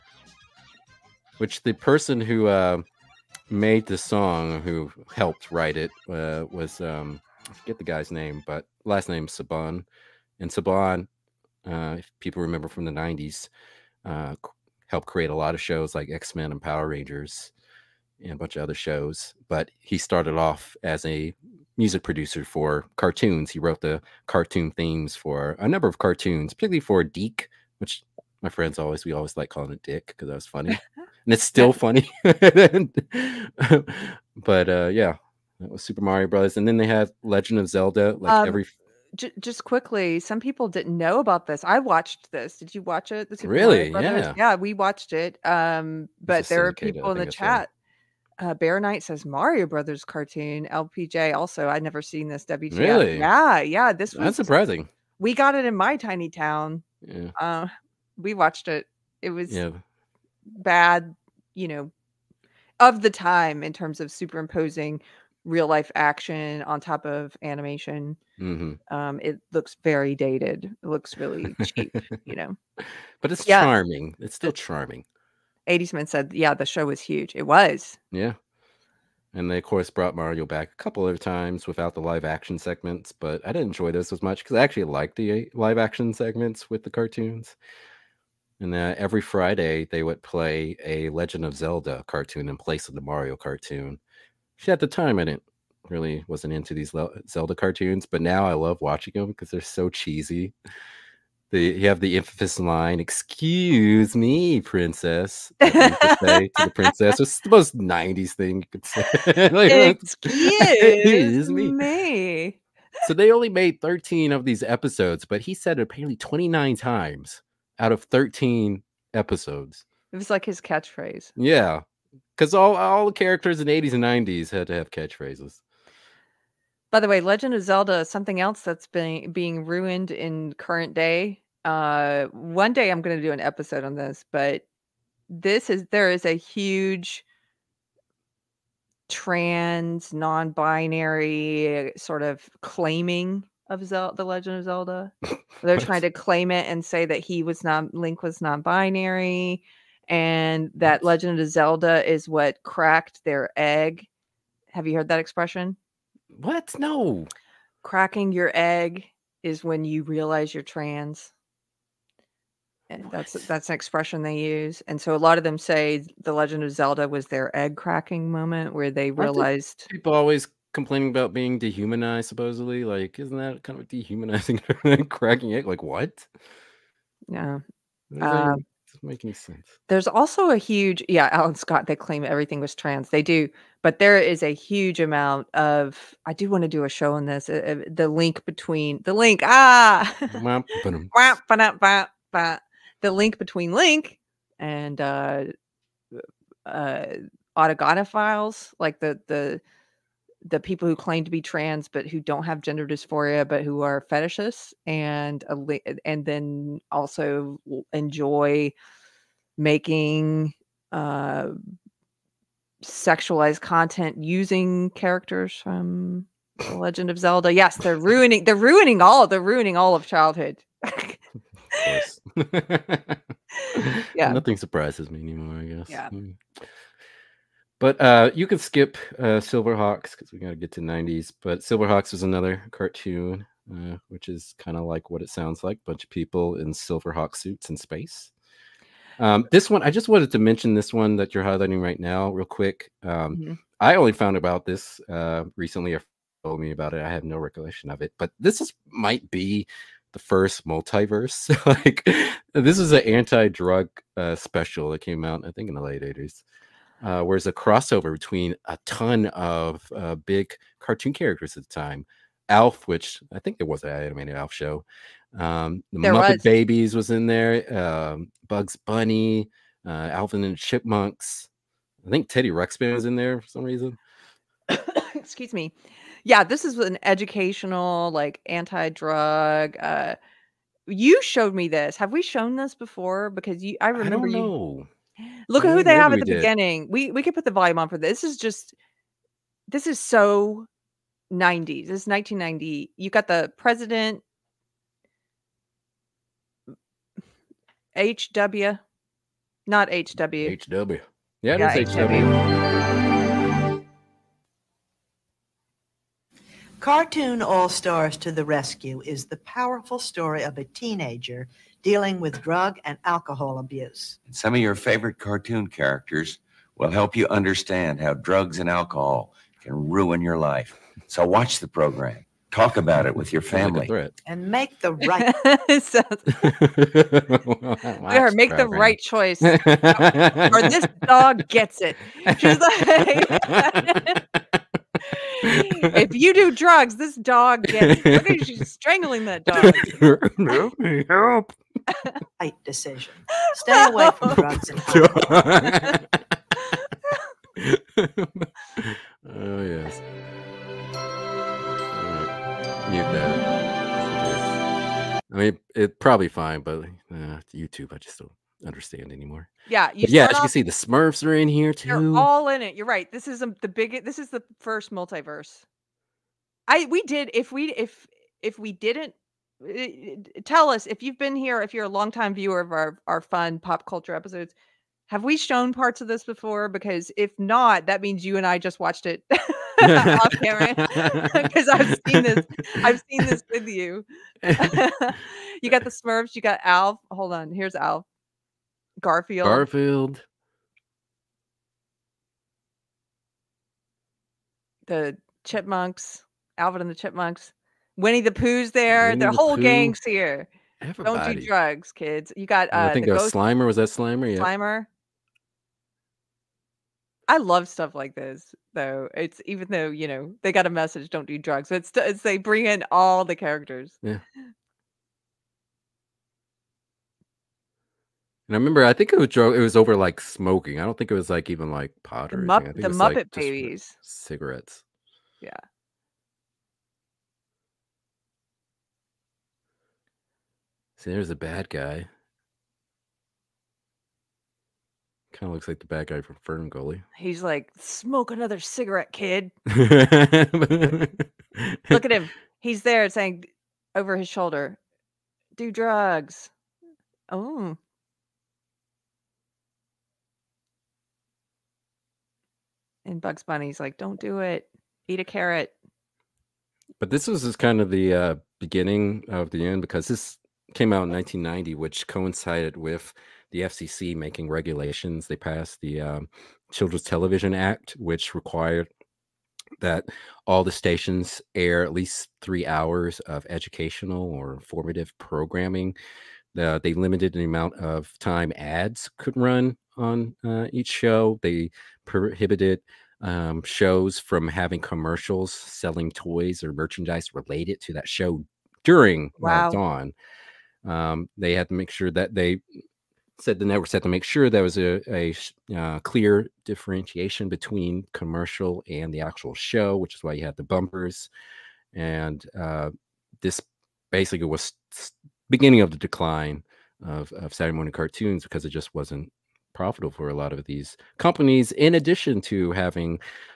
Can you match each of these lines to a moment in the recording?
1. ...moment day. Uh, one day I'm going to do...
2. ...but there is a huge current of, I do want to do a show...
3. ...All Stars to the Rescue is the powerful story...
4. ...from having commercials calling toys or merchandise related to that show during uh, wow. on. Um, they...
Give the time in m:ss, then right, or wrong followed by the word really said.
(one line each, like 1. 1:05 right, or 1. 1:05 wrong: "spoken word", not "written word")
1. 2:10 wrong: "current", not "moment"
2. 3:03 wrong: "amount", not "current"
3. 5:07 right
4. 8:04 wrong: "selling", not "calling".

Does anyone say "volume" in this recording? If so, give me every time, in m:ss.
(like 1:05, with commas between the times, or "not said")
4:47.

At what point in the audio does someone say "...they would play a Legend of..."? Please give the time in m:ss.
1:29.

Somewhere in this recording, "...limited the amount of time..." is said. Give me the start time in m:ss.
7:56.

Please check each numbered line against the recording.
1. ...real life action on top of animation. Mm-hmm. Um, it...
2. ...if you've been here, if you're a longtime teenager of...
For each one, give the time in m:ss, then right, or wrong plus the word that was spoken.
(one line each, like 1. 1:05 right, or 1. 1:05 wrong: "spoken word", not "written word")
1. 1:05 right
2. 6:10 wrong: "viewer", not "teenager".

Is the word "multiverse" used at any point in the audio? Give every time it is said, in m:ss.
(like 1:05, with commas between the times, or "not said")
4:10, 6:04.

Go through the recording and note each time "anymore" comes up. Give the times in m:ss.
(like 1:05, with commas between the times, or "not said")
3:45, 5:59.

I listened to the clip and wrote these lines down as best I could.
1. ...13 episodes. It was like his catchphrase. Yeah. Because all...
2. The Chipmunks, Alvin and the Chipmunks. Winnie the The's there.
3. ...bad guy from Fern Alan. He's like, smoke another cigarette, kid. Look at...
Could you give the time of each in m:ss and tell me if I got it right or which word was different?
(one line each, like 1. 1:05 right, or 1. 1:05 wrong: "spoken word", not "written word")
1. 1:58 right
2. 6:34 wrong: "Pooh", not "The"
3. 7:15 wrong: "Gully", not "Alan".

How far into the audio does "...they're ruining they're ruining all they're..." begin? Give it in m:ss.
3:37.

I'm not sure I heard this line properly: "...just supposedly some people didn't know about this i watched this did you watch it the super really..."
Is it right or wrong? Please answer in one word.
wrong.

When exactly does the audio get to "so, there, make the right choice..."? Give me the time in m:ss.
5:25.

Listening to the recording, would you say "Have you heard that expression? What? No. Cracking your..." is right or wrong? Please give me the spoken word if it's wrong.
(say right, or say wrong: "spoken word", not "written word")
right.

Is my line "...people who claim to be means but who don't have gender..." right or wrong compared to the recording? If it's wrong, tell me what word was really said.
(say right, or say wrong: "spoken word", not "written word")
wrong: "trans", not "means".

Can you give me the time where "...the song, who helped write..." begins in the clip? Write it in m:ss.
0:03.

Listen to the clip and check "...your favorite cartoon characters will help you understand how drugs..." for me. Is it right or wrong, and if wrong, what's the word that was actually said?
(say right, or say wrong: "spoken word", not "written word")
right.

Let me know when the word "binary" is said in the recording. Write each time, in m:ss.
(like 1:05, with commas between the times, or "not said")
2:20, 2:28.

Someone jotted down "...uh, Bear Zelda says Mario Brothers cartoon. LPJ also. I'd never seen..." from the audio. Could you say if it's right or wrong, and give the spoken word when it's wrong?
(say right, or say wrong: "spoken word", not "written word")
wrong: "Knight", not "Zelda".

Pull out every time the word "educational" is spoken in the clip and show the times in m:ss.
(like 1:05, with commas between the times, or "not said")
4:37, 7:53.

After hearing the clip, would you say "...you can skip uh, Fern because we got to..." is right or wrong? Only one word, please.
wrong.